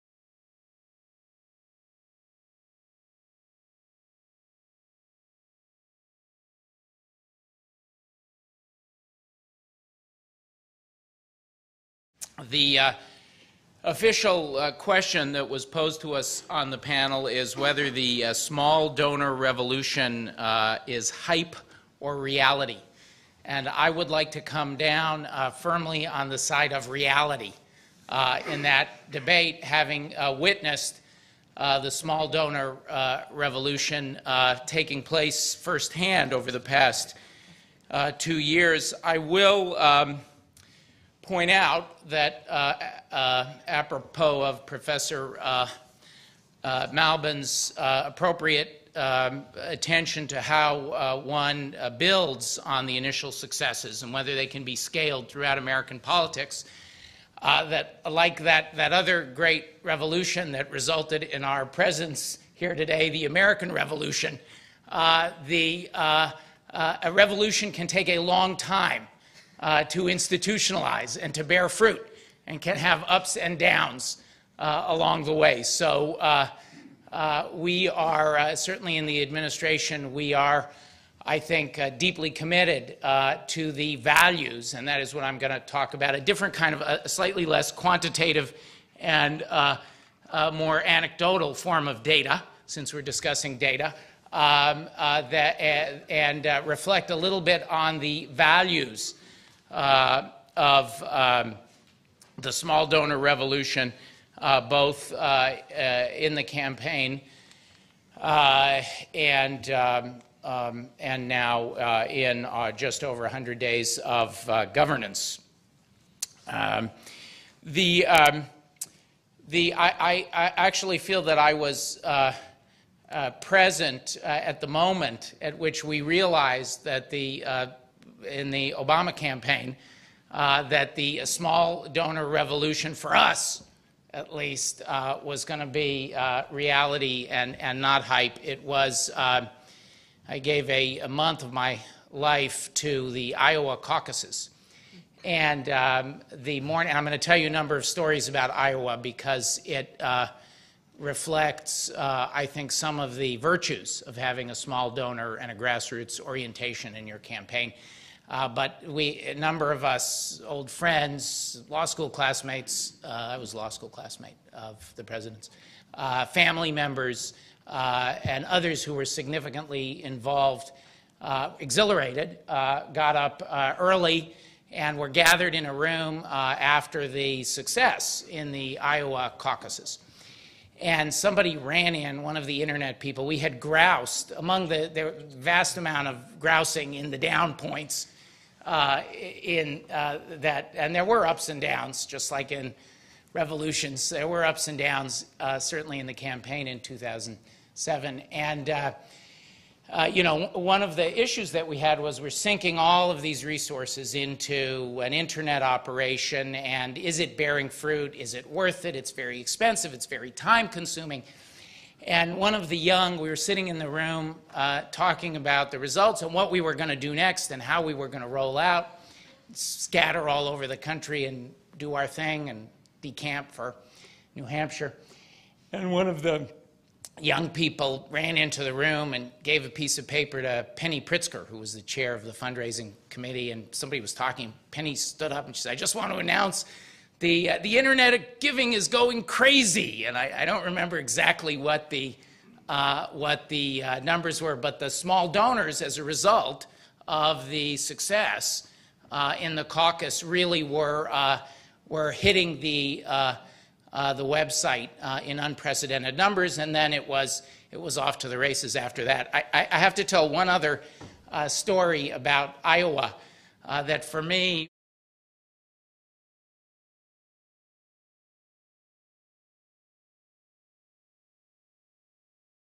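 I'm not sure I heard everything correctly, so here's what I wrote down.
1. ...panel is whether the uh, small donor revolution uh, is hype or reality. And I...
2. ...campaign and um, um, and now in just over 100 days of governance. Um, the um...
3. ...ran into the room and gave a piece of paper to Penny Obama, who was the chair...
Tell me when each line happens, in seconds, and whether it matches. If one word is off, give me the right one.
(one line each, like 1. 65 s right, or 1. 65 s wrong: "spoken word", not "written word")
1. 16 s right
2. 106 s right
3. 228 s wrong: "Pritzker", not "Obama".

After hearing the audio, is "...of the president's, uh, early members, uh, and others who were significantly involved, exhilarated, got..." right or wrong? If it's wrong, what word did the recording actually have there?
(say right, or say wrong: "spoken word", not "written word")
wrong: "family", not "early".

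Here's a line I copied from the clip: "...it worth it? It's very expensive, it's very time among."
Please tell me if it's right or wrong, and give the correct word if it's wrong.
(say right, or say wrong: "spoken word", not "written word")
wrong: "consuming", not "among".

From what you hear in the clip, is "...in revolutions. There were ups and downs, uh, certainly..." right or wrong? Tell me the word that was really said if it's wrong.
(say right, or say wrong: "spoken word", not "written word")
right.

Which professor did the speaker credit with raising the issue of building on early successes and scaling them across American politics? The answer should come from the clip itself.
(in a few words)
Malbin.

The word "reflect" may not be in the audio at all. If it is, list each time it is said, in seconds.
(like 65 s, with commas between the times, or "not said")
96 s, 150 s.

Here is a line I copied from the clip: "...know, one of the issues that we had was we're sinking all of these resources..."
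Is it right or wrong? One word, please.
right.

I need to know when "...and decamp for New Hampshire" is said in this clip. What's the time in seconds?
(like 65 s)
222 s.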